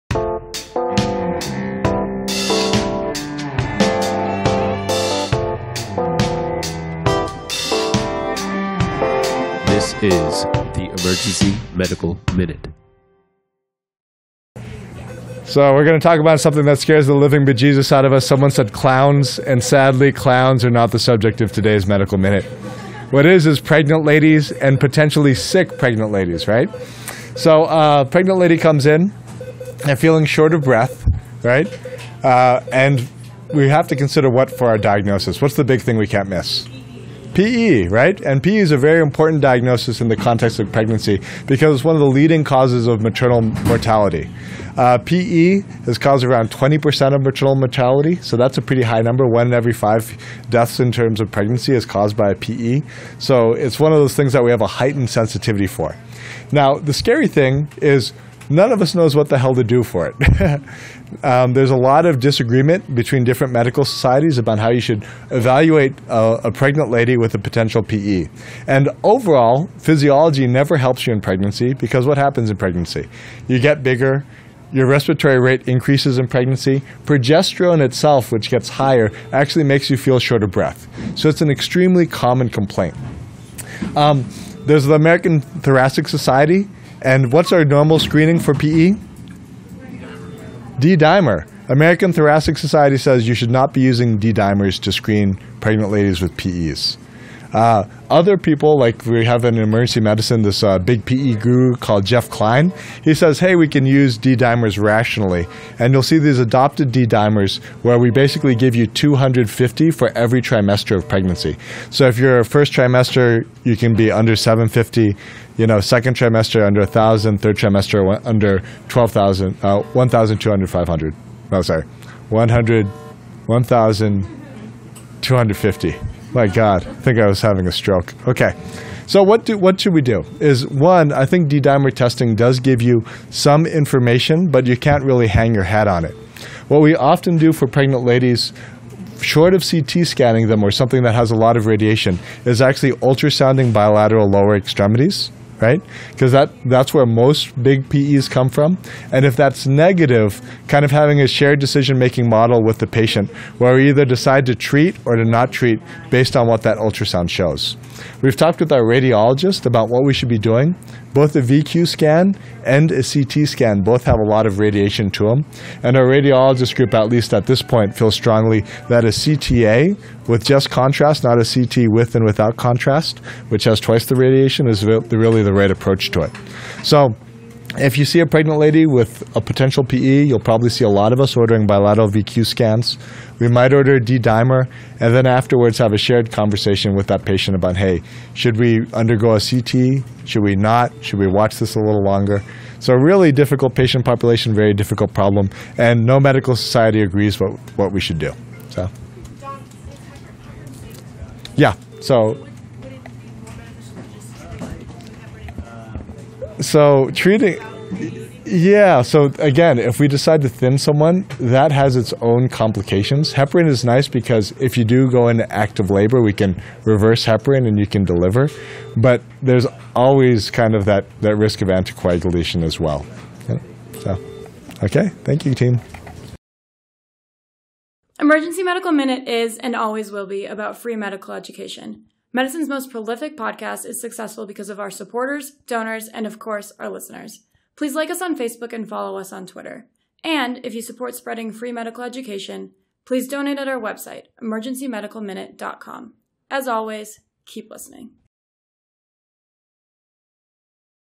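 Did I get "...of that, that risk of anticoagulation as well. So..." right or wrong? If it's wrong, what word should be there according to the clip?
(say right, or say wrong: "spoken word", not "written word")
right.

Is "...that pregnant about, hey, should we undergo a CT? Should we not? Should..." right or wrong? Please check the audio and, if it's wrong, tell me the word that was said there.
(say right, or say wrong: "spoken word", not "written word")
wrong: "patient", not "pregnant".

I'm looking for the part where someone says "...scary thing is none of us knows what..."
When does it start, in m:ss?
0:56.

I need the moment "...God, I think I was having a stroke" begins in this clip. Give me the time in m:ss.
2:06.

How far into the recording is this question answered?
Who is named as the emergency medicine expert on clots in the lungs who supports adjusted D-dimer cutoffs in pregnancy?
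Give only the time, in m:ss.
1:42.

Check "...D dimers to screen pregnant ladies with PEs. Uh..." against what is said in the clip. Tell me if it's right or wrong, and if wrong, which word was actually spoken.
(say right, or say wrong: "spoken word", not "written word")
right.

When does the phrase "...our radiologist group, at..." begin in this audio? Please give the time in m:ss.
2:45.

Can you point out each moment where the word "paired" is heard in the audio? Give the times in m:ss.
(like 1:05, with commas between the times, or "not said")
not said.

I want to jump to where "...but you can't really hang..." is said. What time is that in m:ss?
2:14.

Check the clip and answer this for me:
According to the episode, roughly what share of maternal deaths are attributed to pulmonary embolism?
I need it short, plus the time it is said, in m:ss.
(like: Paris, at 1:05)
20%, at 0:46.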